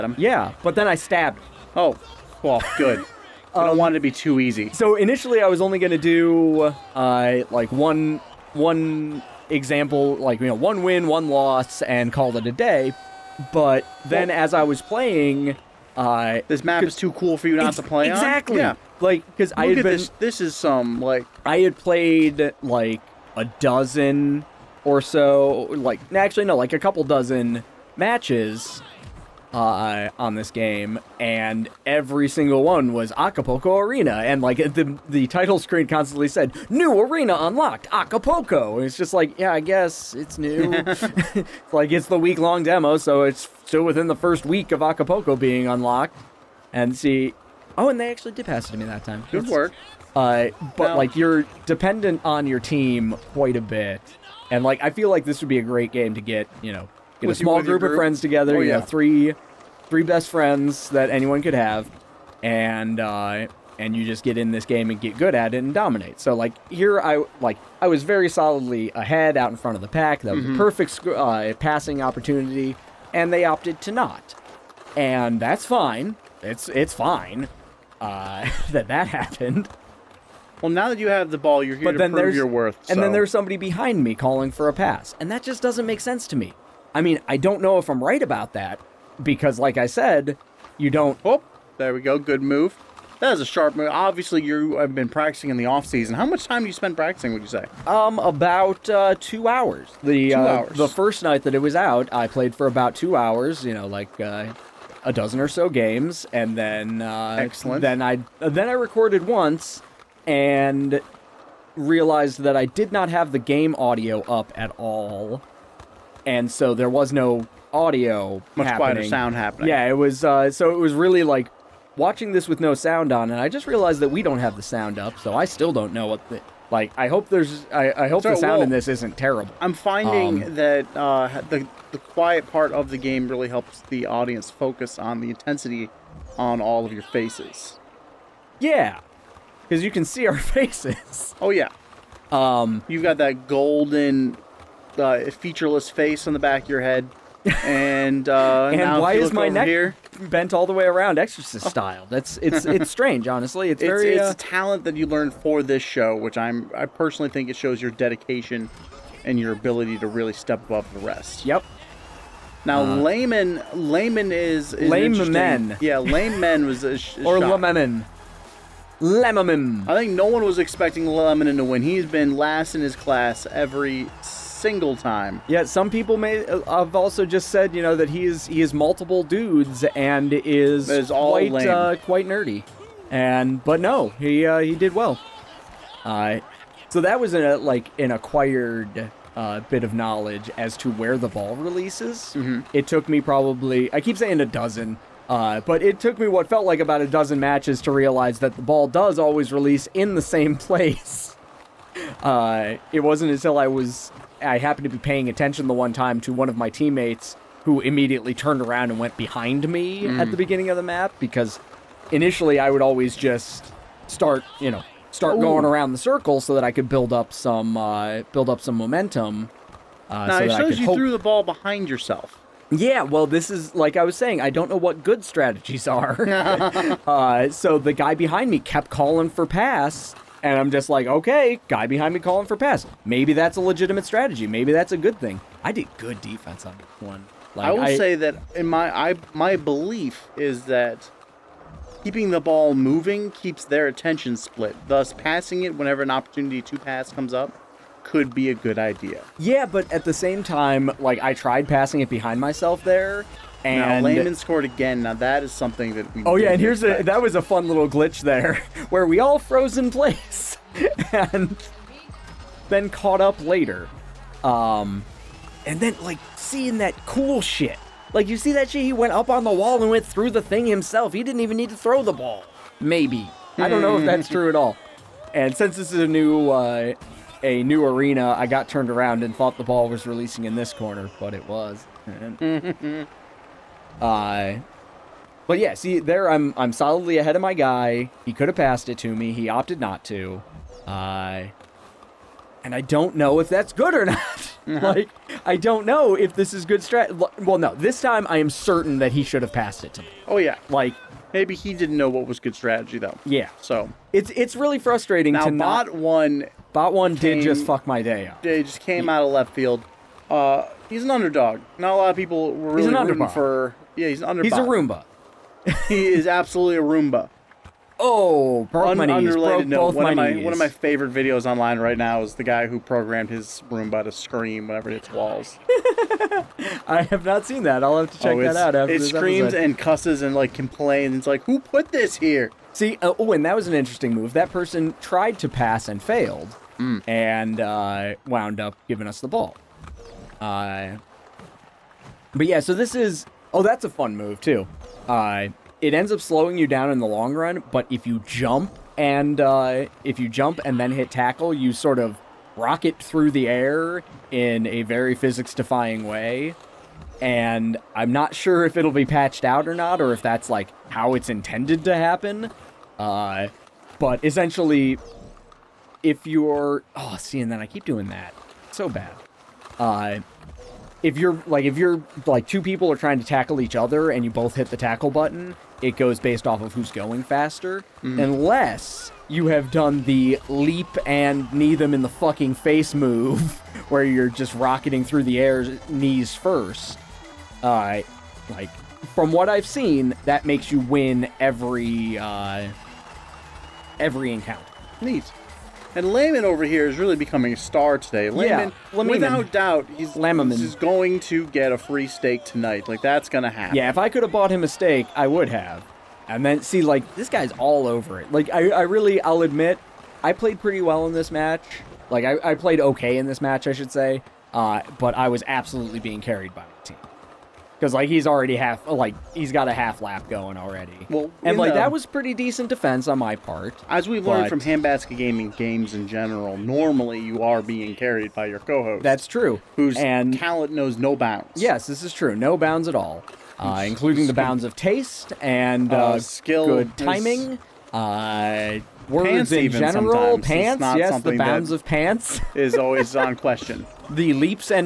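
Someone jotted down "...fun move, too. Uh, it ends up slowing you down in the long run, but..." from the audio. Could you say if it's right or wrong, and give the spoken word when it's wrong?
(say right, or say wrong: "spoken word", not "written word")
right.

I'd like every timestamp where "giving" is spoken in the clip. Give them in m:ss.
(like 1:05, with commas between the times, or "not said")
5:38.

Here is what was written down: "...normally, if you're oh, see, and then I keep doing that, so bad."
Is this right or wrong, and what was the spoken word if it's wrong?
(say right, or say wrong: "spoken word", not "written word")
wrong: "essentially", not "normally".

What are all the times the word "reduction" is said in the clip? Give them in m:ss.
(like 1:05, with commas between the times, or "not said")
not said.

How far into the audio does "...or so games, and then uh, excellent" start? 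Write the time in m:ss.
1:45.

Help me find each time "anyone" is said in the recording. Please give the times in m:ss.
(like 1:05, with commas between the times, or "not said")
1:01.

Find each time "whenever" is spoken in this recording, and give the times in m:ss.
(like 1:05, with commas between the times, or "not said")
4:05, 5:24.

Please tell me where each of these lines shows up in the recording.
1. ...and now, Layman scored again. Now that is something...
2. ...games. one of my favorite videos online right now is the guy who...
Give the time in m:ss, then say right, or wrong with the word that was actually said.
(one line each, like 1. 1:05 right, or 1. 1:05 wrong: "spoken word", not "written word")
1. 4:13 right
2. 5:20 wrong: "knees", not "games".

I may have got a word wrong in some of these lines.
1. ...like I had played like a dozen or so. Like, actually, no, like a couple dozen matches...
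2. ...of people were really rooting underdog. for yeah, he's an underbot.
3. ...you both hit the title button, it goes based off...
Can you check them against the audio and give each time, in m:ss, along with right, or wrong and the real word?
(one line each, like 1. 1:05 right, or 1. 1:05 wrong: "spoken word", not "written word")
1. 0:20 right
2. 5:12 right
3. 6:14 wrong: "tackle", not "title".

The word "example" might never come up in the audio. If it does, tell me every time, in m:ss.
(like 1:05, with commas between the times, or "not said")
0:09.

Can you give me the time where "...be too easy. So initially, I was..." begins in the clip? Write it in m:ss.
0:04.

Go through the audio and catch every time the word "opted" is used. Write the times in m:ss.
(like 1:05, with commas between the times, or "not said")
1:13, 4:49.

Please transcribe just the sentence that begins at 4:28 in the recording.
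Like you see that shit, he went up on the wall and went through the thing himself.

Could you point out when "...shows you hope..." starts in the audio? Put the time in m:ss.
3:40.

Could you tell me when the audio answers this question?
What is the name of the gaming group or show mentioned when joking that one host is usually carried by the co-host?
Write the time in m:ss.
7:04.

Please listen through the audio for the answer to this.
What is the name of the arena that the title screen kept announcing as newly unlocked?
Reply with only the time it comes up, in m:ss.
0:33.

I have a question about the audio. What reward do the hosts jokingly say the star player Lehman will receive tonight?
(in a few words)
a free steak.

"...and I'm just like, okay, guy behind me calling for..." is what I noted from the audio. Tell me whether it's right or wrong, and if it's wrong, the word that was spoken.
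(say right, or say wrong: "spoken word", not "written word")
right.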